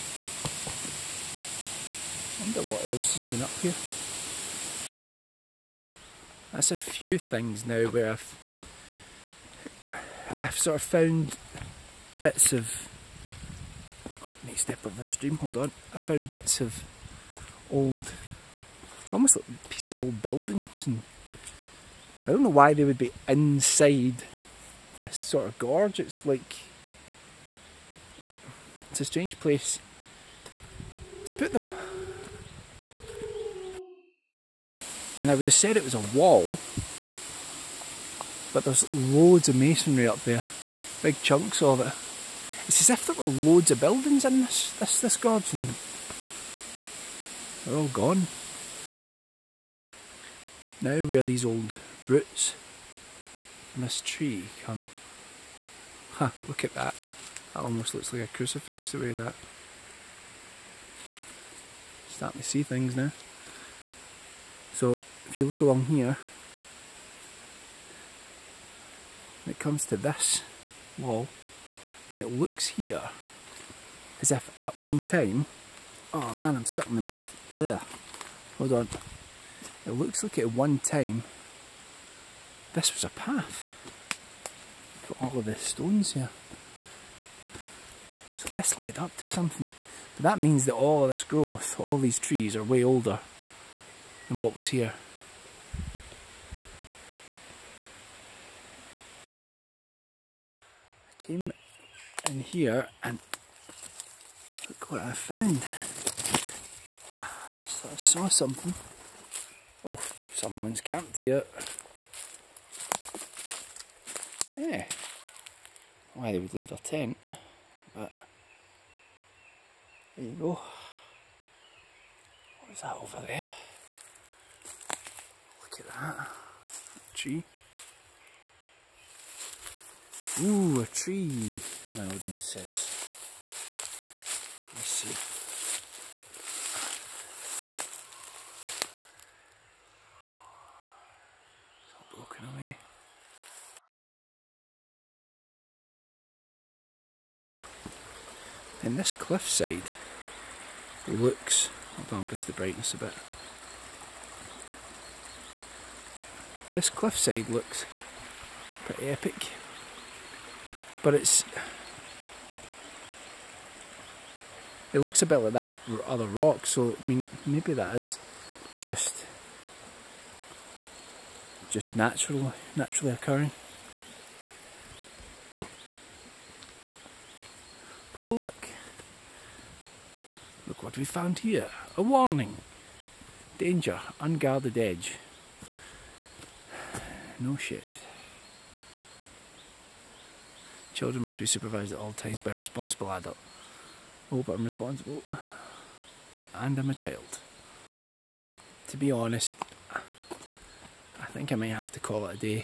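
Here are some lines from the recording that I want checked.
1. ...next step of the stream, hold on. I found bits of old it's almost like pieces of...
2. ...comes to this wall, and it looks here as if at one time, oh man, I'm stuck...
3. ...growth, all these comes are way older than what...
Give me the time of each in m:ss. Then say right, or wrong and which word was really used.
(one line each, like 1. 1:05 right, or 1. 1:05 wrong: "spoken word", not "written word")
1. 0:14 right
2. 1:09 right
3. 1:31 wrong: "trees", not "comes".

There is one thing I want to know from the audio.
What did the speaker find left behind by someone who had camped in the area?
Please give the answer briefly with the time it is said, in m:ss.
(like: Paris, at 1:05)
Their tent, at 1:56.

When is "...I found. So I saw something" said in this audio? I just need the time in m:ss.
1:45.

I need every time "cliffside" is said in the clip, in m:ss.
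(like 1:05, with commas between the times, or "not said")
2:29, 2:36.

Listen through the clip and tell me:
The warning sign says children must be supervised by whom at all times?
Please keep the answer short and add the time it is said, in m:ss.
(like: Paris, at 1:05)
A responsible adult, at 3:12.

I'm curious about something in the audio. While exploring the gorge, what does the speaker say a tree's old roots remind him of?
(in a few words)
A crucifix.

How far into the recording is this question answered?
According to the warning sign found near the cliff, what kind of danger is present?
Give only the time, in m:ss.
3:04.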